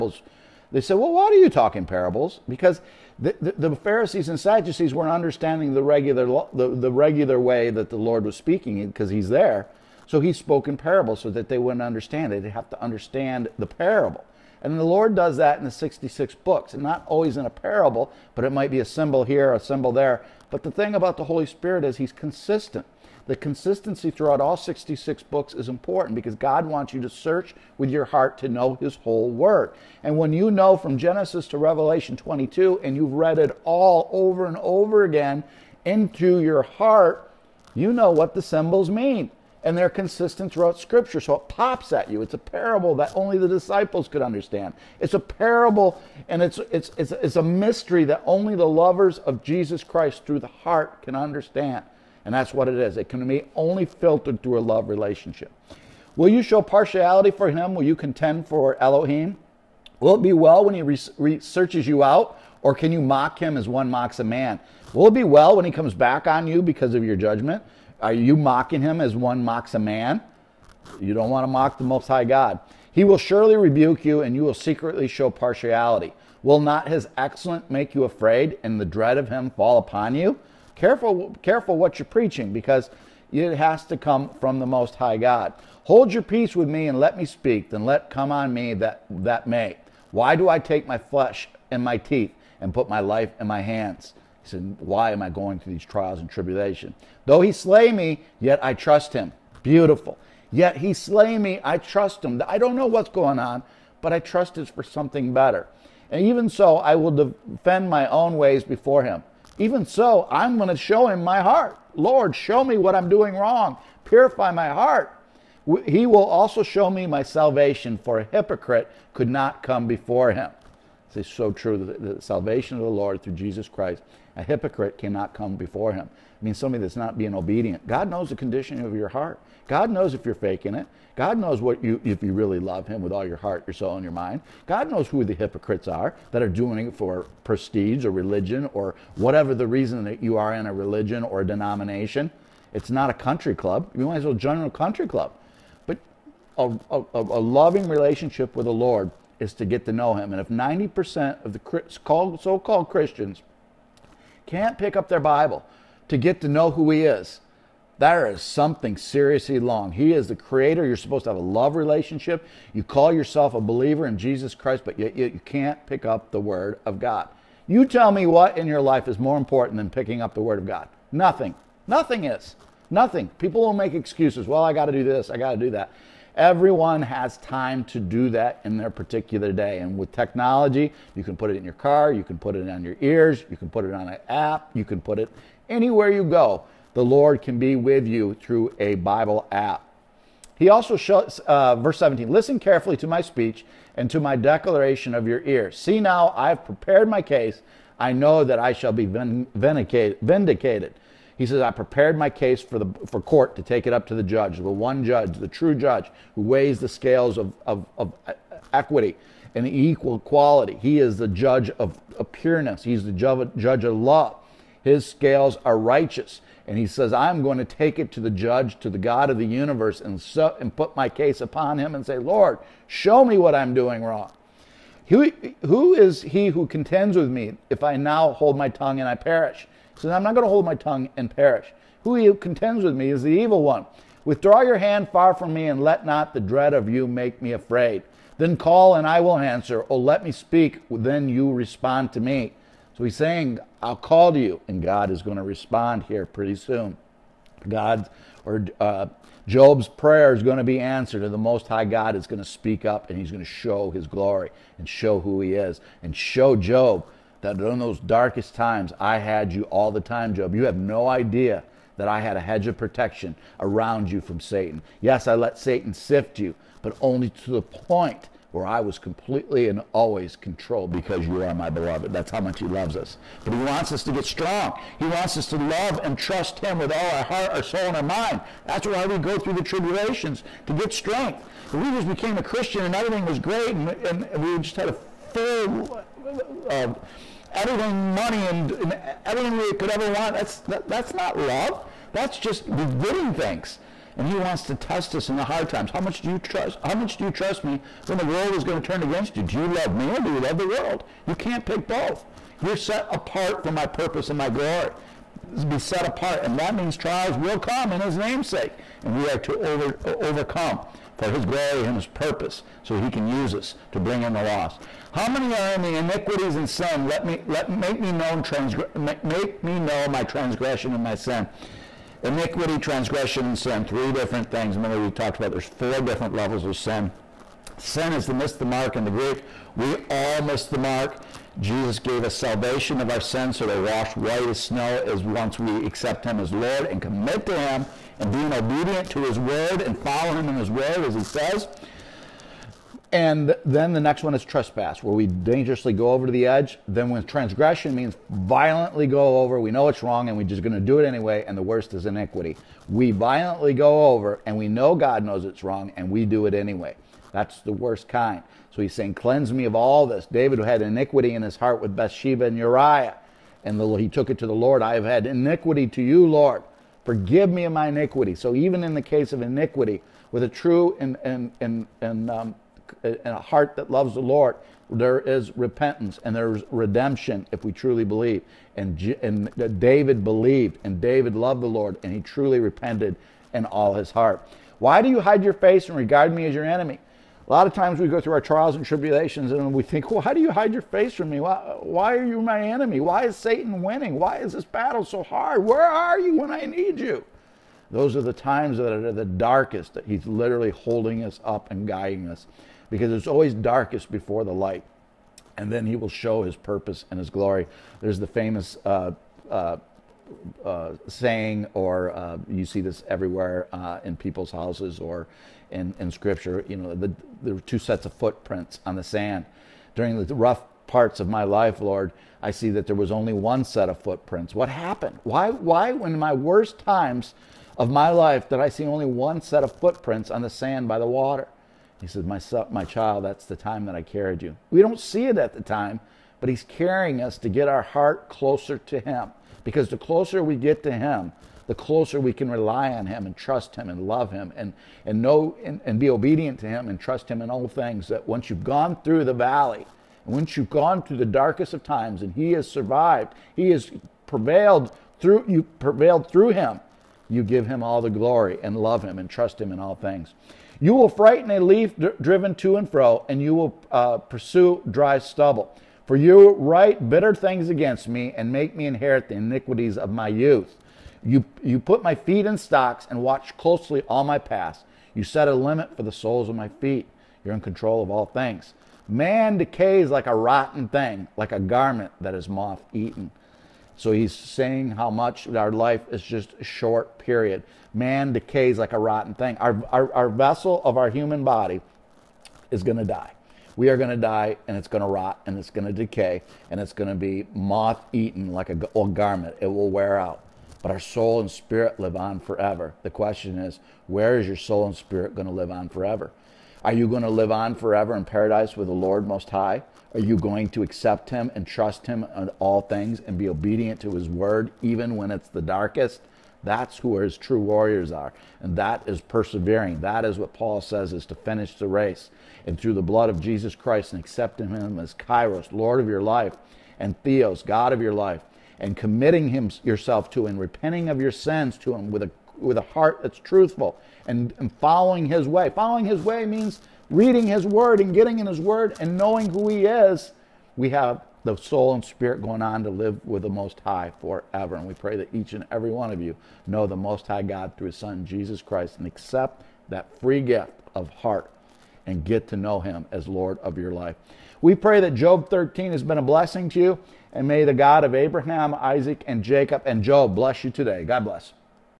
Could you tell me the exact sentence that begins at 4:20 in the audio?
You have no idea that I had a hedge of protection around you from Satan.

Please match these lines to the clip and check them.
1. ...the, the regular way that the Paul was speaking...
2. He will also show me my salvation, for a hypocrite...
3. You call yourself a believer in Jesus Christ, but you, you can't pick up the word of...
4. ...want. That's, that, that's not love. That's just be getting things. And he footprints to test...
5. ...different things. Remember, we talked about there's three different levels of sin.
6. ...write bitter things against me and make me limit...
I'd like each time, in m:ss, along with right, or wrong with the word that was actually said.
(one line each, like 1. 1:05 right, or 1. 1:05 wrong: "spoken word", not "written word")
1. 0:06 wrong: "Lord", not "Paul"
2. 1:55 right
3. 2:42 right
4. 4:50 wrong: "wants", not "footprints"
5. 5:24 wrong: "four", not "three"
6. 7:46 wrong: "inherit", not "limit".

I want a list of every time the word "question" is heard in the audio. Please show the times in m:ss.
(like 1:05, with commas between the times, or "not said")
8:23.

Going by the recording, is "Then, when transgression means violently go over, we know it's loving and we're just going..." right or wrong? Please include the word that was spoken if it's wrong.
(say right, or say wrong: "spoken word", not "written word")
wrong: "wrong", not "loving".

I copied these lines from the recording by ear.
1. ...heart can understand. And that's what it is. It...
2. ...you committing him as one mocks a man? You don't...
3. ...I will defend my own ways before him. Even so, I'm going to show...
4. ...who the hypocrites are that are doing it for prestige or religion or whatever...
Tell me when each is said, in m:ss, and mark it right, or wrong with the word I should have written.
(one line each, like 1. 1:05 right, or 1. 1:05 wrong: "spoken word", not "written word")
1. 0:50 right
2. 1:08 wrong: "mocking", not "committing"
3. 1:46 right
4. 2:15 right.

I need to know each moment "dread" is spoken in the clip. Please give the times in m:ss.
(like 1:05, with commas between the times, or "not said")
1:18, 3:56.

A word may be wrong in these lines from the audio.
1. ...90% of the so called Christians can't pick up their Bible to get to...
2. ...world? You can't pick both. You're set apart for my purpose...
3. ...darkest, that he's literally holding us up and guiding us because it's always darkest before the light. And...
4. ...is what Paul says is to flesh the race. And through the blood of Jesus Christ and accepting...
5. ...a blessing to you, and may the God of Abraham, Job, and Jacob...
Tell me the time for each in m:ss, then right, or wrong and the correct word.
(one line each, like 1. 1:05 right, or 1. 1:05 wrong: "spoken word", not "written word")
1. 2:30 right
2. 5:00 right
3. 6:39 right
4. 8:40 wrong: "finish", not "flesh"
5. 9:16 wrong: "Isaac", not "Job".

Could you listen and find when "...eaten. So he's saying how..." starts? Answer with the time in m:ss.
8:02.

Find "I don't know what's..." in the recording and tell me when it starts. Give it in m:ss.
1:42.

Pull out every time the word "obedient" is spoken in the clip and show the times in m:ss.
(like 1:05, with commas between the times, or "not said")
2:07, 5:38, 7:26, 8:33.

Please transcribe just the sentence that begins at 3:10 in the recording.
He also shows, uh, verse 17, listen carefully to my speech and to my declaration of your ear.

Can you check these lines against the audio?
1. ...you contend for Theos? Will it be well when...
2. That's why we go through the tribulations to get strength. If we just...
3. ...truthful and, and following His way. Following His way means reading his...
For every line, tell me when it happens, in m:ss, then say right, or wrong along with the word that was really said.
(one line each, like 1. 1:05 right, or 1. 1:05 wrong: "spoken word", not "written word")
1. 0:57 wrong: "Elohim", not "Theos"
2. 4:38 right
3. 8:53 right.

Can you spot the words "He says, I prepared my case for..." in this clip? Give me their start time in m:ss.
3:21.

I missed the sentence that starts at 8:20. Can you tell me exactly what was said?
But our soul and spirit live on forever.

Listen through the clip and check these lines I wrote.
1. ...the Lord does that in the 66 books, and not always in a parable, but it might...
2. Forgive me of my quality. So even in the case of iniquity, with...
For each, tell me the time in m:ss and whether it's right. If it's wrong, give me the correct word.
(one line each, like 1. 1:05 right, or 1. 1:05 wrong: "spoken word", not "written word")
1. 0:14 right
2. 6:07 wrong: "iniquity", not "quality".